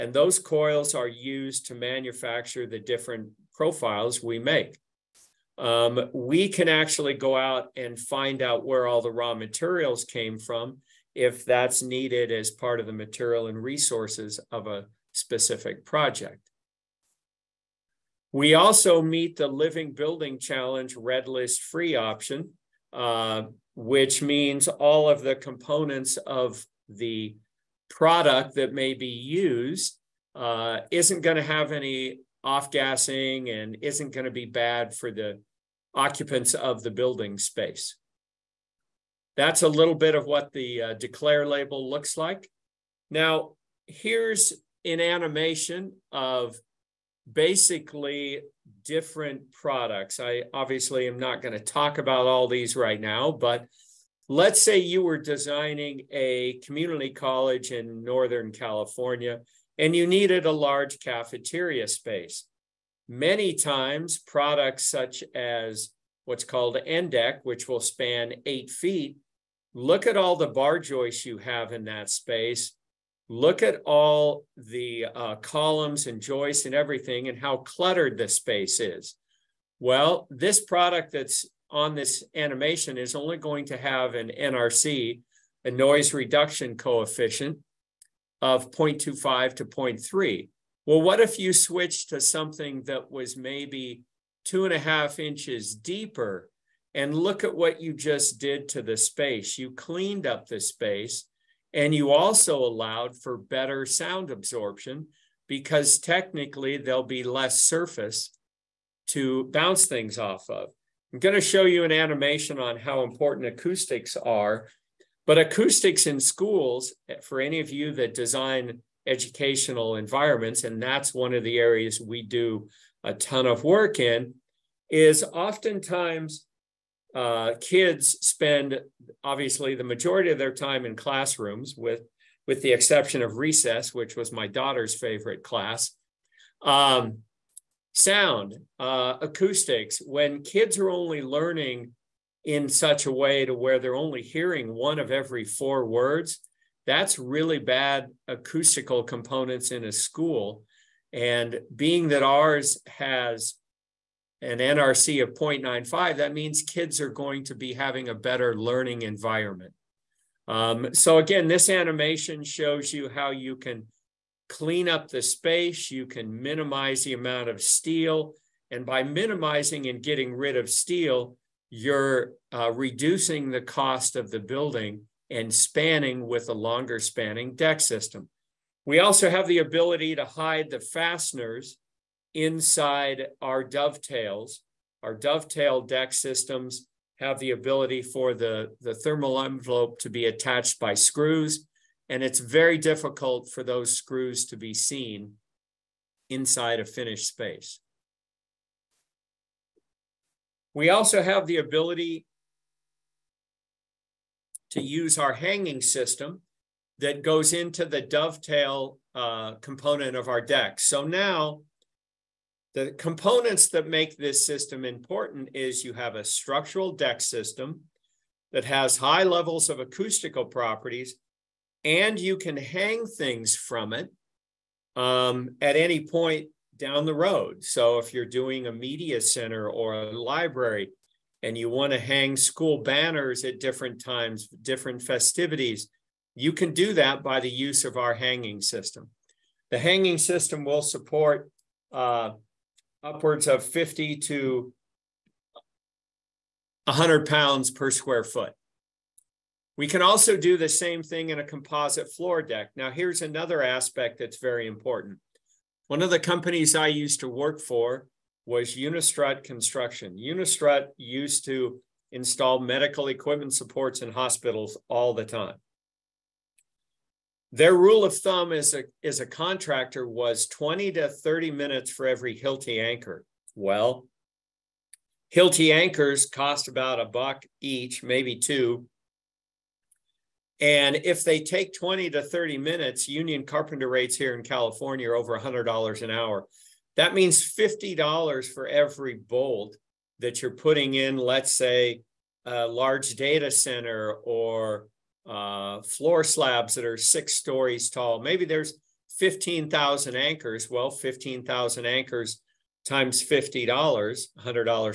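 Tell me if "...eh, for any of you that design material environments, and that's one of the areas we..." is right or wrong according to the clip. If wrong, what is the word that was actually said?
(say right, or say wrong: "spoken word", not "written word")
wrong: "educational", not "material".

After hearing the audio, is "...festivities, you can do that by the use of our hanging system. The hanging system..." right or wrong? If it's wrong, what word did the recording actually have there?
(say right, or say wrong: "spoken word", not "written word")
right.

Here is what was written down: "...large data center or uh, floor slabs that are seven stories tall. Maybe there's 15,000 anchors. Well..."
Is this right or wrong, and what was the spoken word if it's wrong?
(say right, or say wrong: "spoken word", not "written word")
wrong: "six", not "seven".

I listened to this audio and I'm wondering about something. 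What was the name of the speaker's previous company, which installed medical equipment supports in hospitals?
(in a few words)
Unistrut Construction.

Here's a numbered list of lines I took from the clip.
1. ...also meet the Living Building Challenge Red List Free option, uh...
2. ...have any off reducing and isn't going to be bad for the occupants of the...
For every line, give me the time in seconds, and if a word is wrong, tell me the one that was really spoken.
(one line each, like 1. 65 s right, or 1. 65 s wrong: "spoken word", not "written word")
1. 18 s right
2. 31 s wrong: "gassing", not "reducing".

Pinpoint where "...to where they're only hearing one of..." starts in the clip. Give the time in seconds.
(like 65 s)
143 s.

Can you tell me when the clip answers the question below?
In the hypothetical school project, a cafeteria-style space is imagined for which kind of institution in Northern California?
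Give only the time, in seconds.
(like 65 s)
56 s.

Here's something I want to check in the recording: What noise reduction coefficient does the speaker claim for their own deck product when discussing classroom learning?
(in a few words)
0.95.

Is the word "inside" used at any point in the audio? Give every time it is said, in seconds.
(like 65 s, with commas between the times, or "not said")
182 s, 196 s.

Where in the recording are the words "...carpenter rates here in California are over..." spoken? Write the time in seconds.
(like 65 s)
283 s.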